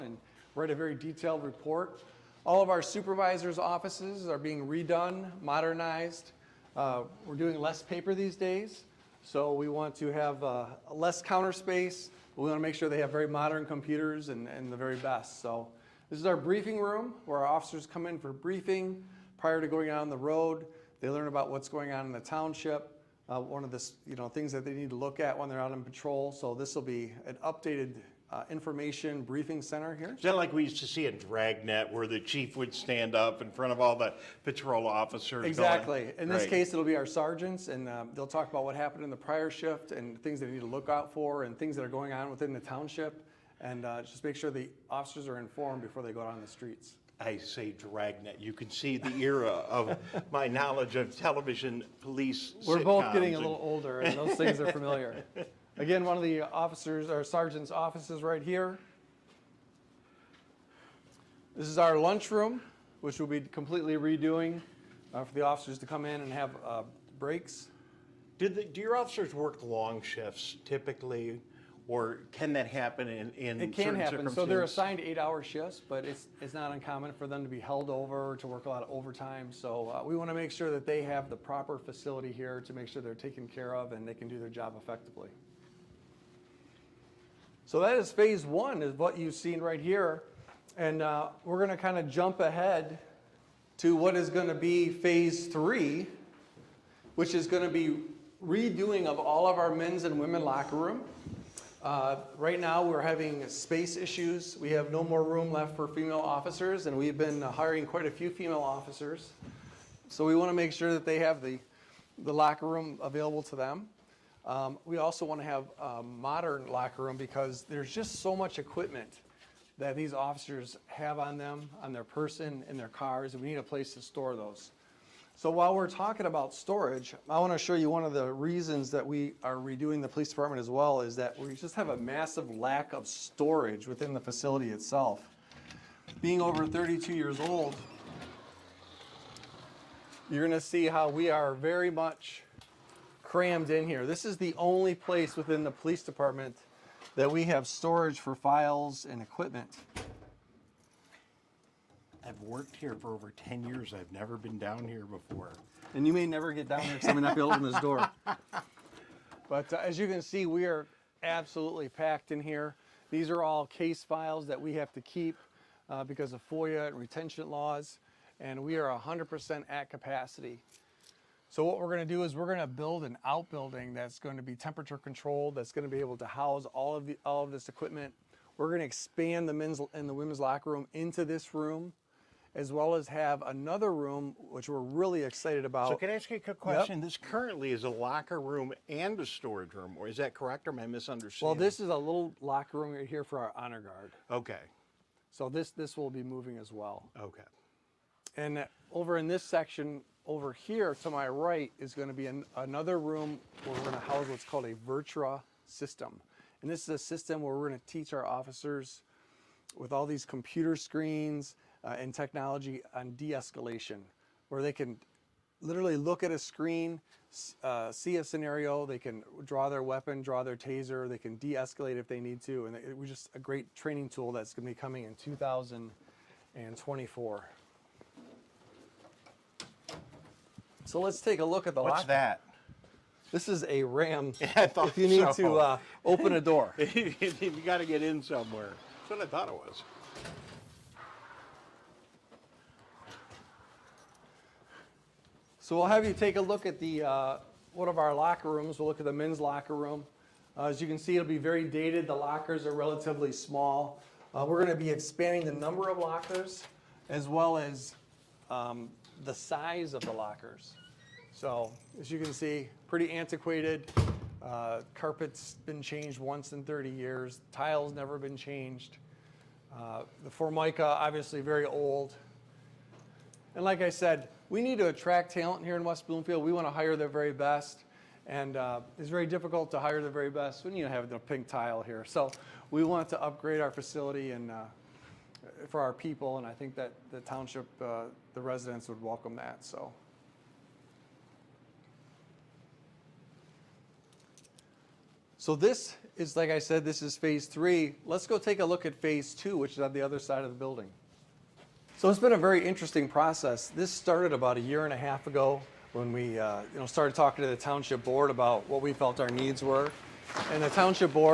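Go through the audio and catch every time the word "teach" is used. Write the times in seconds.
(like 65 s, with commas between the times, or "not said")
207 s.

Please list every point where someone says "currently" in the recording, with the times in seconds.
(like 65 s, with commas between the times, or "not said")
187 s.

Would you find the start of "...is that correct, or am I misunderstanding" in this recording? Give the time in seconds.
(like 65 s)
190 s.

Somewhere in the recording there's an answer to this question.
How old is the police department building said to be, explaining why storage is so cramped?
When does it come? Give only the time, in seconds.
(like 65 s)
136 s.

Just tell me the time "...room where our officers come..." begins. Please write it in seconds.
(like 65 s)
16 s.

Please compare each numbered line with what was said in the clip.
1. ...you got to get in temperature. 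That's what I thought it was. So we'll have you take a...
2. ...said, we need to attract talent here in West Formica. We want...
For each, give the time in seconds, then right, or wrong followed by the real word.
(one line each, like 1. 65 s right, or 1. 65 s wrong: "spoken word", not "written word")
1. 236 s wrong: "somewhere", not "temperature"
2. 273 s wrong: "Bloomfield", not "Formica".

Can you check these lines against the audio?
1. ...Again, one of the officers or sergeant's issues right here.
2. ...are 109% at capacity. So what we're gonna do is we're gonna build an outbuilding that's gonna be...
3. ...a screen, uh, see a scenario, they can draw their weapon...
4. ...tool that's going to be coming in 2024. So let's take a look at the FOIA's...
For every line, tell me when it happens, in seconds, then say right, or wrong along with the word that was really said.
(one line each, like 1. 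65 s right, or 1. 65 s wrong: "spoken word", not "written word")
1. 55 s wrong: "offices", not "issues"
2. 168 s wrong: "100", not "109"
3. 216 s right
4. 224 s wrong: "What", not "FOIA".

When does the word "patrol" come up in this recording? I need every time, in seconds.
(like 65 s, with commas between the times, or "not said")
25 s, 34 s.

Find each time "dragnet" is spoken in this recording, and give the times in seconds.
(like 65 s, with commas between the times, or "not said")
31 s, 47 s.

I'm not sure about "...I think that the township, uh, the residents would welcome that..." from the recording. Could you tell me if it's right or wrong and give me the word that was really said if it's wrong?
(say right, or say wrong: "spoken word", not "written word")
right.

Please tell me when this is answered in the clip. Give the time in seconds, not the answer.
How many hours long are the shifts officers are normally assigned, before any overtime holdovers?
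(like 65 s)
74 s.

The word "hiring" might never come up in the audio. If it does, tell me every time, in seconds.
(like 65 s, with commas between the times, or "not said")
107 s.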